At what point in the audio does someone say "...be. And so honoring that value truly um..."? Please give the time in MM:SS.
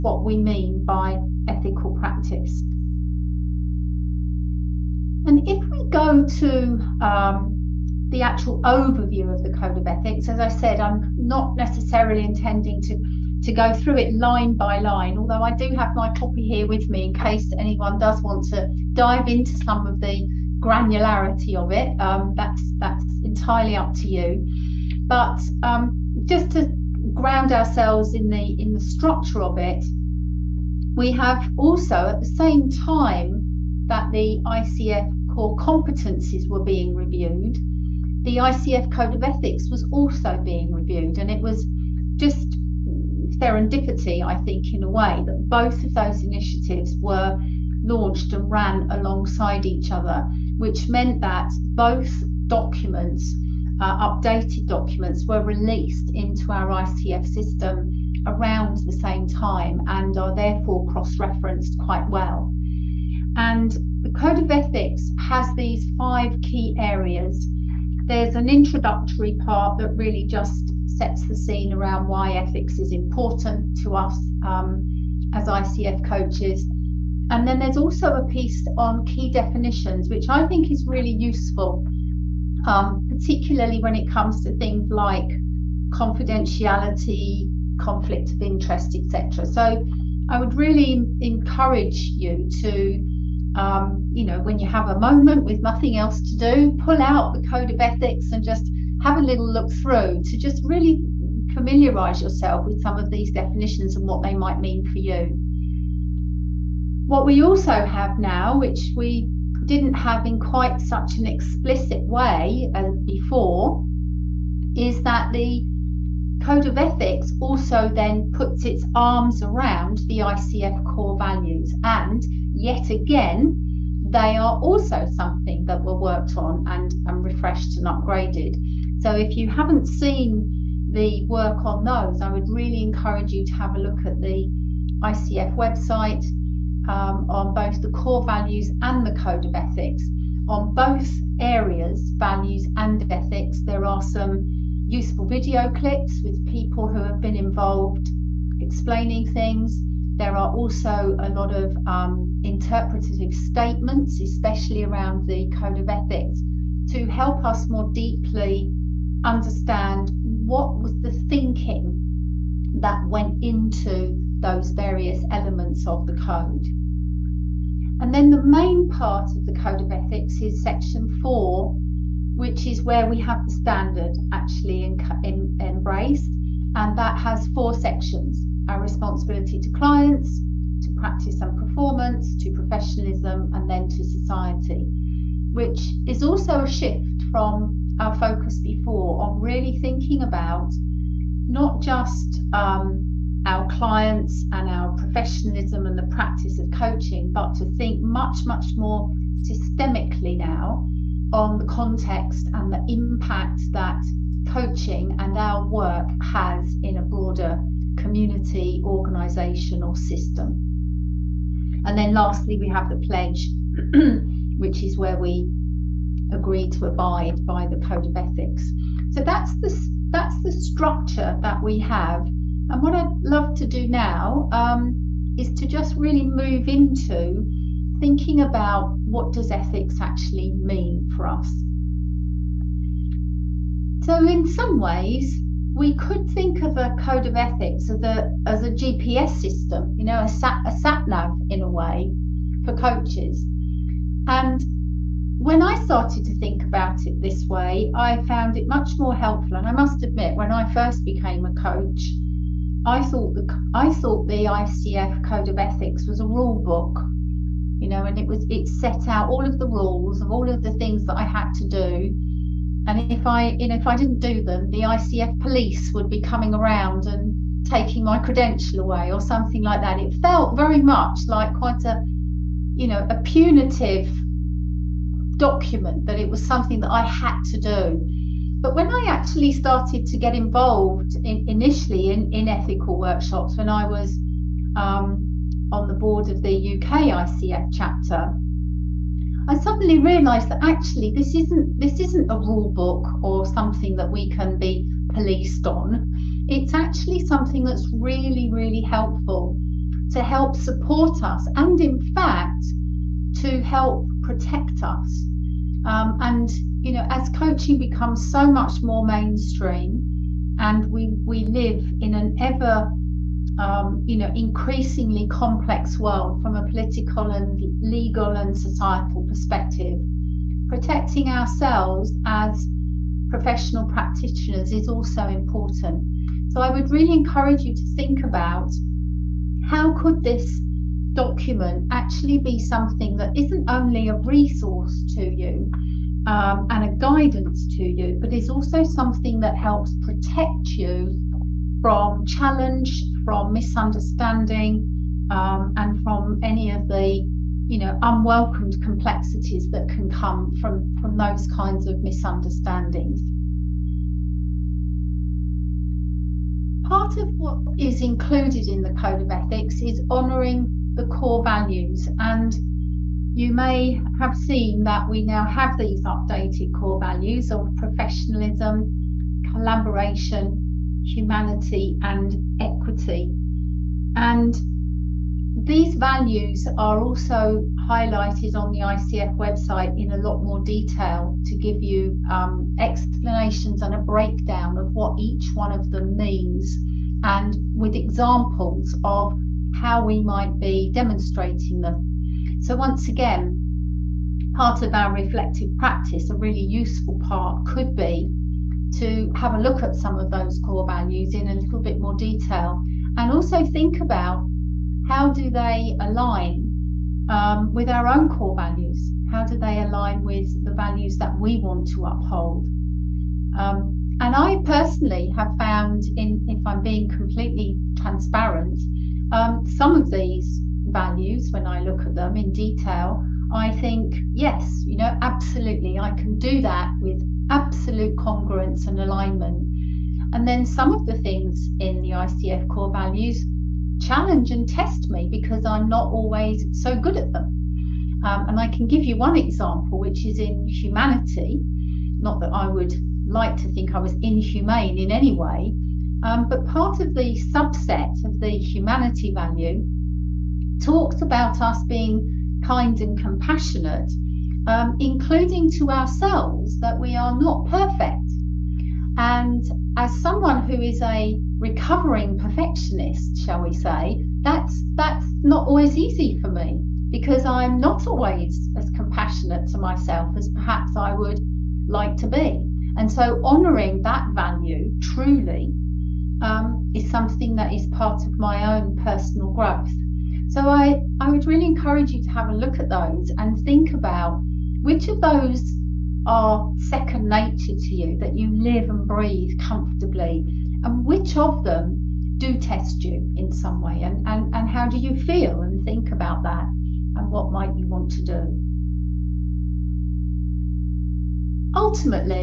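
07:52.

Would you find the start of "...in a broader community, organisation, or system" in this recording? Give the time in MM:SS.
03:26.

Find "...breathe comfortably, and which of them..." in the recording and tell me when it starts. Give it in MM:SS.
08:09.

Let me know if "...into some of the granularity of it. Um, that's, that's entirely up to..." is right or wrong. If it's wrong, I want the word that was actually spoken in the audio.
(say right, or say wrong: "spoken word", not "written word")
right.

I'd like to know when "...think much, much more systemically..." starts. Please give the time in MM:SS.
03:17.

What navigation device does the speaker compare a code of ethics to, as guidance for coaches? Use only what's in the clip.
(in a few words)
GPS system.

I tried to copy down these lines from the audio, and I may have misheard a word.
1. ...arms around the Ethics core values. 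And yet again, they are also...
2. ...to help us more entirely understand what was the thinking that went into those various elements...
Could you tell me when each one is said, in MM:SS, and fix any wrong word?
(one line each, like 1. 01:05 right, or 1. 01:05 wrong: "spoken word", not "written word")
1. 01:58 wrong: "ICF", not "Ethics"
2. 02:36 wrong: "deeply", not "entirely".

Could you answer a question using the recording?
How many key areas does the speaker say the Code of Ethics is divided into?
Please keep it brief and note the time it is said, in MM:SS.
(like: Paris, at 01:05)
5, at 01:05.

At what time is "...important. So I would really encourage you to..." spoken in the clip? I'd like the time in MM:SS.
05:25.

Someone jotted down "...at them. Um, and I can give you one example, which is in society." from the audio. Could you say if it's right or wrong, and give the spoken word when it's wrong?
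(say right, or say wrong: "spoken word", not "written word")
wrong: "humanity", not "society".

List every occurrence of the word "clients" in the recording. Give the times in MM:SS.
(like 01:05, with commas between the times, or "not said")
02:59, 03:13.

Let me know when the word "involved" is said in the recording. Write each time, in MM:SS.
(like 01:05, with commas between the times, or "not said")
02:27, 04:40.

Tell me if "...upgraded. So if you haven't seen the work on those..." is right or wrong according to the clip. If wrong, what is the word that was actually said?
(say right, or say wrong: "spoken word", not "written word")
right.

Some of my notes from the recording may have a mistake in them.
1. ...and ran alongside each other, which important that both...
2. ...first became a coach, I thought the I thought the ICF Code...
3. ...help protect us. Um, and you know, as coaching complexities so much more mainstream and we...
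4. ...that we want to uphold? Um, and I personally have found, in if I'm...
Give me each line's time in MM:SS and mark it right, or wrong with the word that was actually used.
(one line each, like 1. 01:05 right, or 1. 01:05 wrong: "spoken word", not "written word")
1. 00:48 wrong: "meant", not "important"
2. 04:10 right
3. 05:03 wrong: "becomes", not "complexities"
4. 06:51 right.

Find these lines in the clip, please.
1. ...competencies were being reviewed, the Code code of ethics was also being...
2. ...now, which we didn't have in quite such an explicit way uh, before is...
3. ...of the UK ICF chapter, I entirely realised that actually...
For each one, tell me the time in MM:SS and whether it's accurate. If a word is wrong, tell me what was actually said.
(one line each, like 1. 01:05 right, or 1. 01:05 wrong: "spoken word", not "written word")
1. 00:35 wrong: "ICF", not "Code"
2. 01:48 right
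3. 04:46 wrong: "suddenly", not "entirely".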